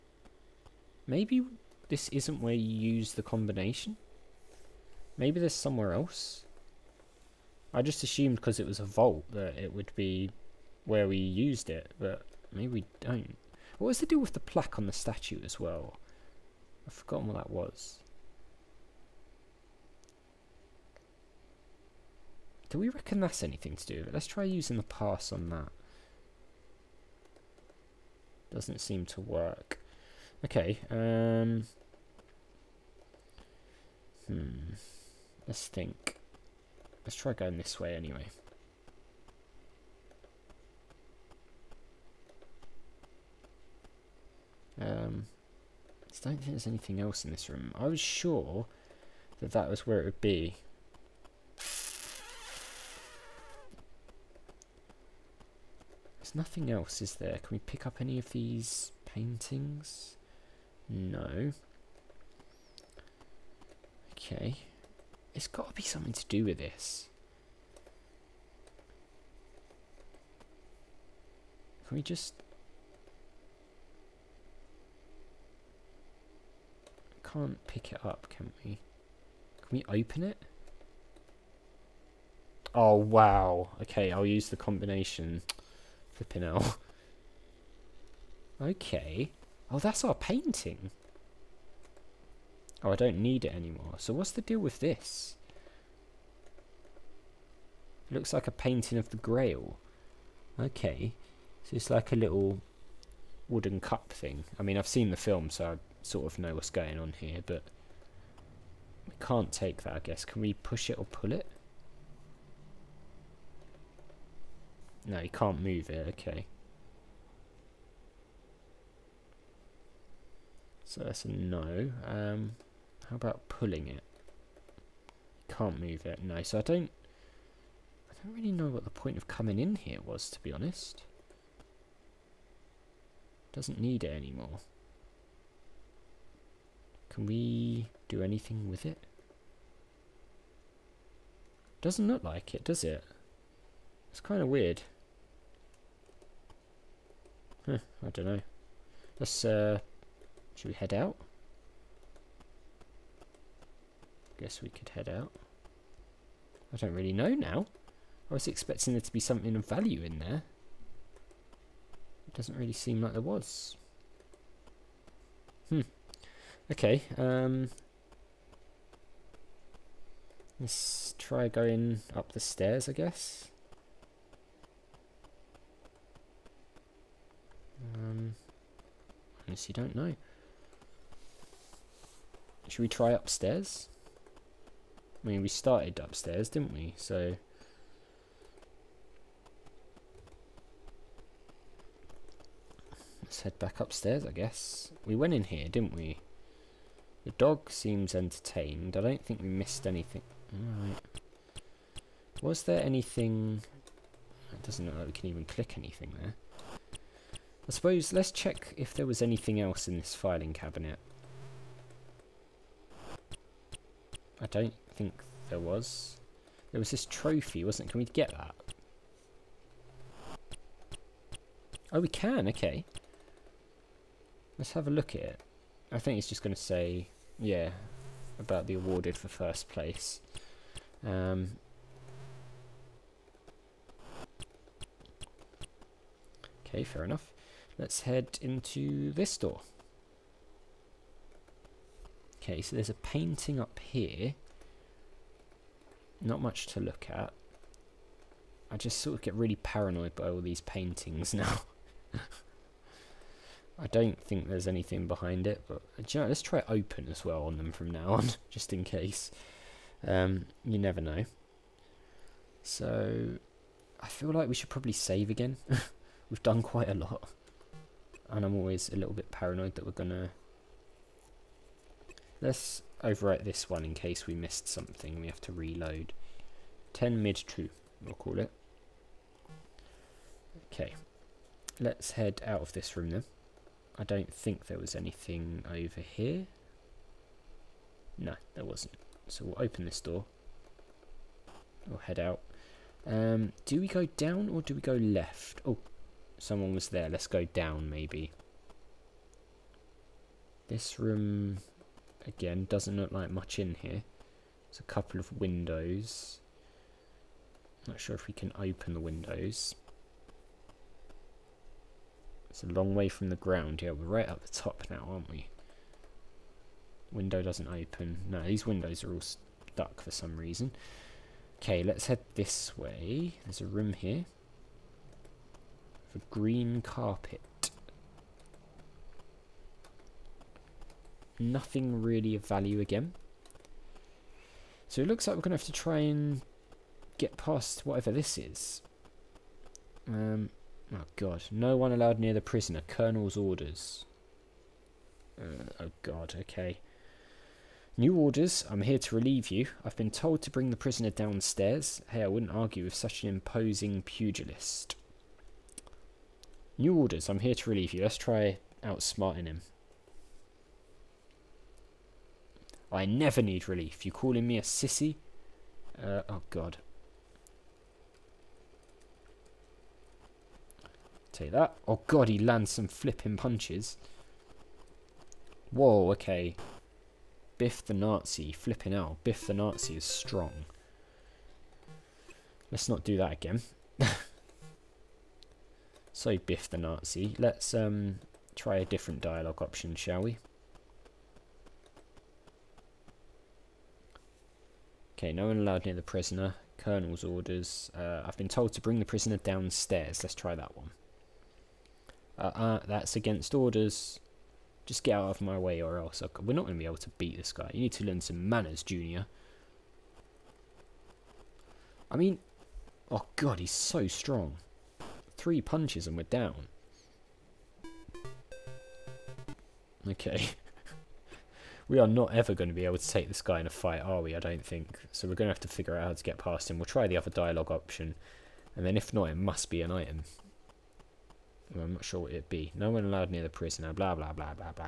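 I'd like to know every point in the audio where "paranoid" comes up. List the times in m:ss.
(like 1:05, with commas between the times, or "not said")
4:09, 4:29.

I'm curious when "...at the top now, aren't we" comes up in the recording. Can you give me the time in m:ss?
5:14.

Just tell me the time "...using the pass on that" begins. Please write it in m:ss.
0:24.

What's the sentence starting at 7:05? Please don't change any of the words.
So we're going to have to figure out how to get past him.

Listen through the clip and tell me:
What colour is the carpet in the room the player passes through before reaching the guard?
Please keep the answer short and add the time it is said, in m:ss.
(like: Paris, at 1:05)
Green, at 5:26.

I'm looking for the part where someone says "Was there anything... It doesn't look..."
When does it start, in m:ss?
3:22.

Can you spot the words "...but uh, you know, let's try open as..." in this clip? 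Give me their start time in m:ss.
4:15.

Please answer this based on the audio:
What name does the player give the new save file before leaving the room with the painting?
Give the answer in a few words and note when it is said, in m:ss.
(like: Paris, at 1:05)
10 mid true, at 4:36.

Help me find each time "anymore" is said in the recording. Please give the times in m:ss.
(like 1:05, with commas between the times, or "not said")
1:33, 2:14.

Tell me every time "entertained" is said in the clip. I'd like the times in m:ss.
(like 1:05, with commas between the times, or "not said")
3:18.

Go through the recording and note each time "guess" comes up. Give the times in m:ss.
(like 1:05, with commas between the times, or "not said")
1:49, 2:34, 2:52, 3:14.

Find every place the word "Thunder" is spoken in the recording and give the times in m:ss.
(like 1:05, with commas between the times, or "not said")
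not said.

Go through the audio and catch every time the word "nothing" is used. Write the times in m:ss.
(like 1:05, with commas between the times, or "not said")
0:56, 5:31.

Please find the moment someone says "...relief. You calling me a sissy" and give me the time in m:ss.
6:03.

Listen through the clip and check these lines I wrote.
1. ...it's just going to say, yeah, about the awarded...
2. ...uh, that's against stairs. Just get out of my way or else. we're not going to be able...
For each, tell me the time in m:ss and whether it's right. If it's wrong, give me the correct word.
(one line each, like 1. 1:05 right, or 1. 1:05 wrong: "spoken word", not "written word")
1. 3:46 right
2. 6:42 wrong: "orders", not "stairs".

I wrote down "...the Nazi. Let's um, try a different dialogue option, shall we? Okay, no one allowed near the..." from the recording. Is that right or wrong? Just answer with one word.
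right.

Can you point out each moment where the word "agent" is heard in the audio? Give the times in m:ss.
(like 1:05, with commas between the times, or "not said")
not said.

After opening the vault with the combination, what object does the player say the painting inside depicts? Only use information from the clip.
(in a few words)
The Grail.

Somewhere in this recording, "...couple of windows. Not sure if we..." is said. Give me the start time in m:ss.
5:04.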